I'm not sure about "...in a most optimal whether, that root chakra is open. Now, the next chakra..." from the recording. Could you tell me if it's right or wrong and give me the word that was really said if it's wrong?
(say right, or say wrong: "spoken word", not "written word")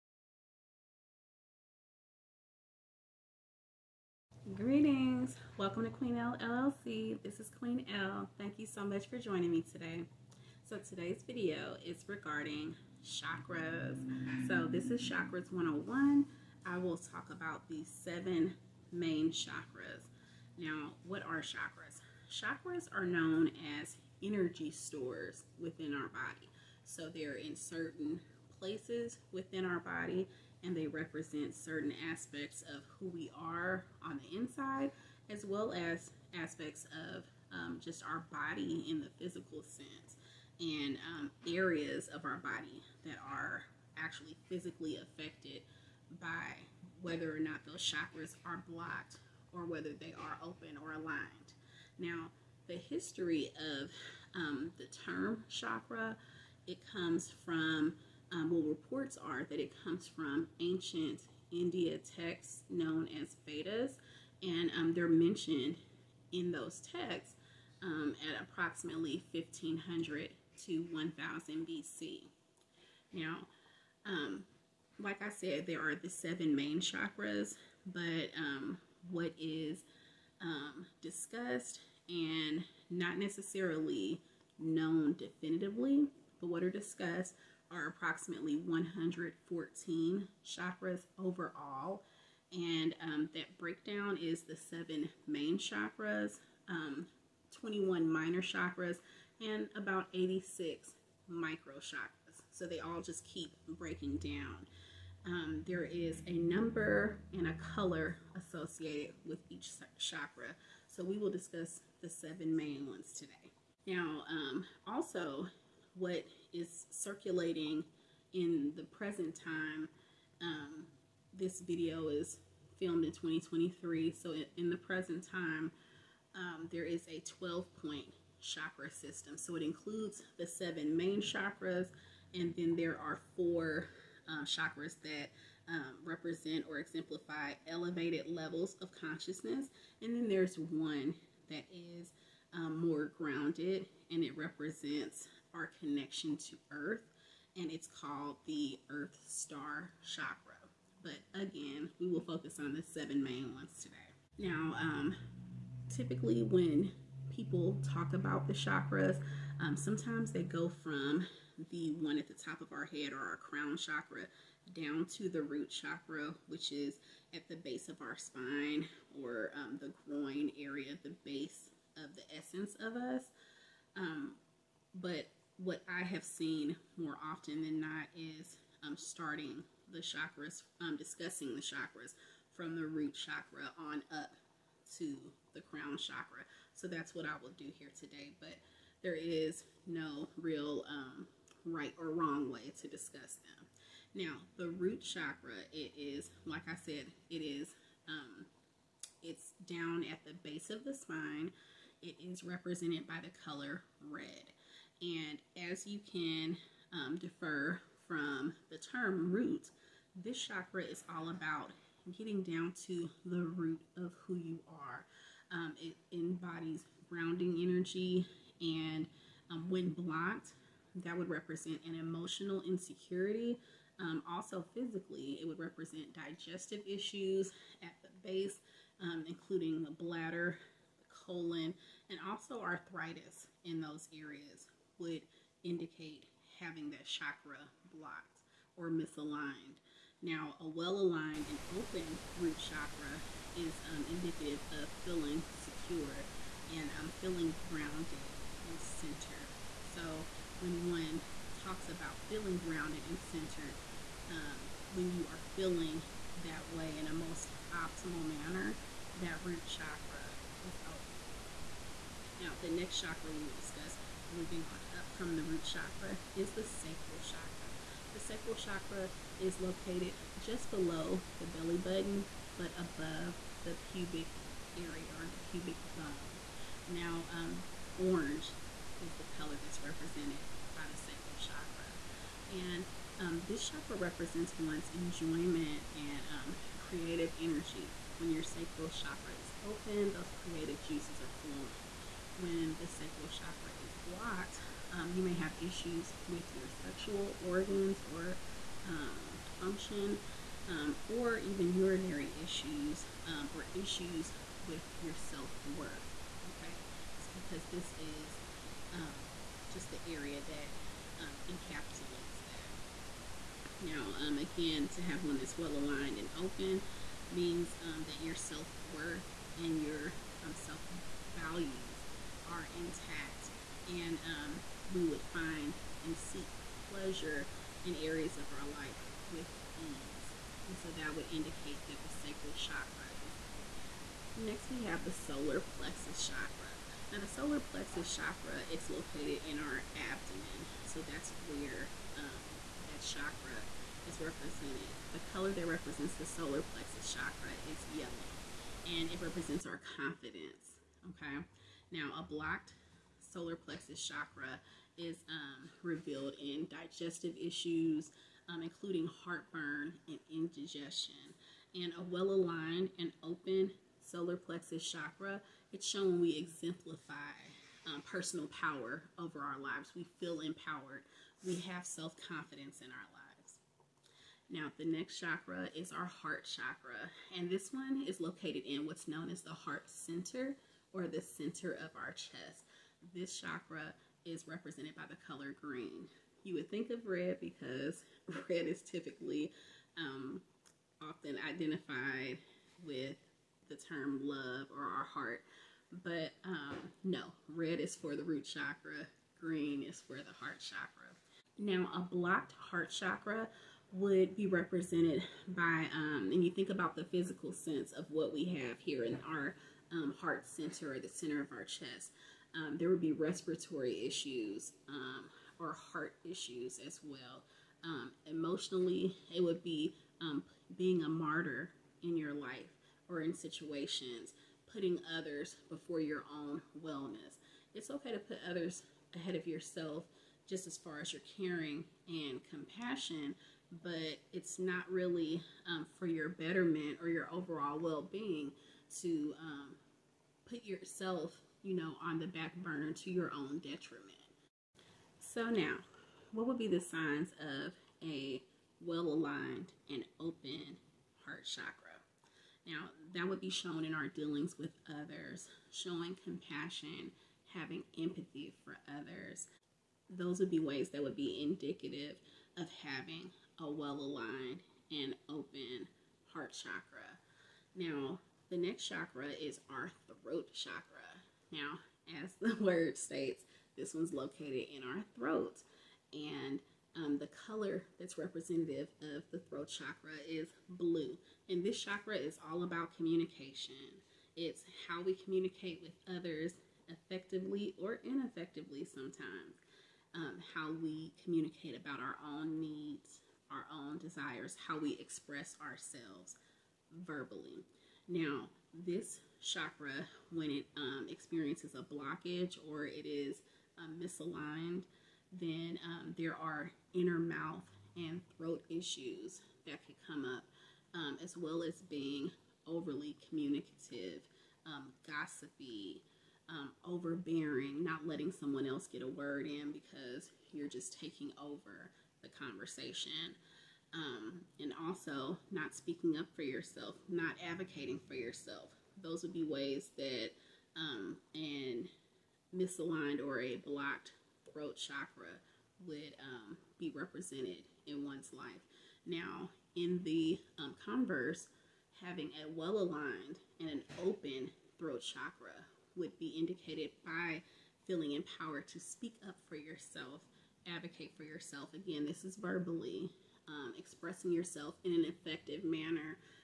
wrong: "manner", not "whether".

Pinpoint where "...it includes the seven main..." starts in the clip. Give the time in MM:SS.
02:09.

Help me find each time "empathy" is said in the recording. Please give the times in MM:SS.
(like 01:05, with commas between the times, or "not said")
07:38.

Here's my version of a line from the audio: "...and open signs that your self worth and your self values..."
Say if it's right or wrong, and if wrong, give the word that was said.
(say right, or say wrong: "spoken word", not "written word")
wrong: "means", not "signs".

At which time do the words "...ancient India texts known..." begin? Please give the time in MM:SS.
01:00.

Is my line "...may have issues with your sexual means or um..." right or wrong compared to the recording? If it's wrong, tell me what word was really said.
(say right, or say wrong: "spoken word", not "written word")
wrong: "organs", not "means".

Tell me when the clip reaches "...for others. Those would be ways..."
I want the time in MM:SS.
07:38.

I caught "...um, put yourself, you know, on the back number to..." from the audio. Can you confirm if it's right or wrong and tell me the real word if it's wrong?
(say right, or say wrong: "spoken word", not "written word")
wrong: "burner", not "number".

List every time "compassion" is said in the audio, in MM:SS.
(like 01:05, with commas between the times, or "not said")
07:12, 07:36.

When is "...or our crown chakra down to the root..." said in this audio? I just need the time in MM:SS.
02:43.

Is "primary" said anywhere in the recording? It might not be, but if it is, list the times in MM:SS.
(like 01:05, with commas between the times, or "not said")
not said.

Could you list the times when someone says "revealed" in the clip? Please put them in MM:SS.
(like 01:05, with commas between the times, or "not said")
05:55.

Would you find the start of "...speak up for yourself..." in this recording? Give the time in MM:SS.
09:08.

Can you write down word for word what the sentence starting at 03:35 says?
Um, it embodies grounding energy, and um, when blocked, that would represent an emotional insecurity.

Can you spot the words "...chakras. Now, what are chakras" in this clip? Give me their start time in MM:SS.
00:19.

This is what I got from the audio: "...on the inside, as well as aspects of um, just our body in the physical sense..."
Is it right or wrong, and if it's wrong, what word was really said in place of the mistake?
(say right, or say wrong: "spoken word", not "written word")
right.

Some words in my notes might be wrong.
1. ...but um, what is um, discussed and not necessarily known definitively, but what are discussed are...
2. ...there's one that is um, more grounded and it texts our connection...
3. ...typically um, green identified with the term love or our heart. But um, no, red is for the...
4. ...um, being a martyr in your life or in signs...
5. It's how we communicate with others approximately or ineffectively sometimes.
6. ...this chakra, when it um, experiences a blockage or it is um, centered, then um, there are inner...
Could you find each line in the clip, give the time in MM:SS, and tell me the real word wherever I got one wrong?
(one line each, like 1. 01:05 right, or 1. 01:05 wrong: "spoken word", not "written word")
1. 01:17 right
2. 02:20 wrong: "represents", not "texts"
3. 06:28 wrong: "often", not "green"
4. 07:00 wrong: "situations", not "signs"
5. 08:04 wrong: "effectively", not "approximately"
6. 08:18 wrong: "misaligned", not "centered".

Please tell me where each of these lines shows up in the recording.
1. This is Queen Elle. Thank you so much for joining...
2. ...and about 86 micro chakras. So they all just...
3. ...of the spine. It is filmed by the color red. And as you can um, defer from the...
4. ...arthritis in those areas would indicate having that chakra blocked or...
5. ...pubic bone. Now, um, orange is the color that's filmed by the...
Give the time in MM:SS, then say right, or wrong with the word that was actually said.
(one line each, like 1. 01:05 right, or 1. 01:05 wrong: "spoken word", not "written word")
1. 00:07 right
2. 01:39 right
3. 03:20 wrong: "represented", not "filmed"
4. 03:52 right
5. 04:35 wrong: "represented", not "filmed".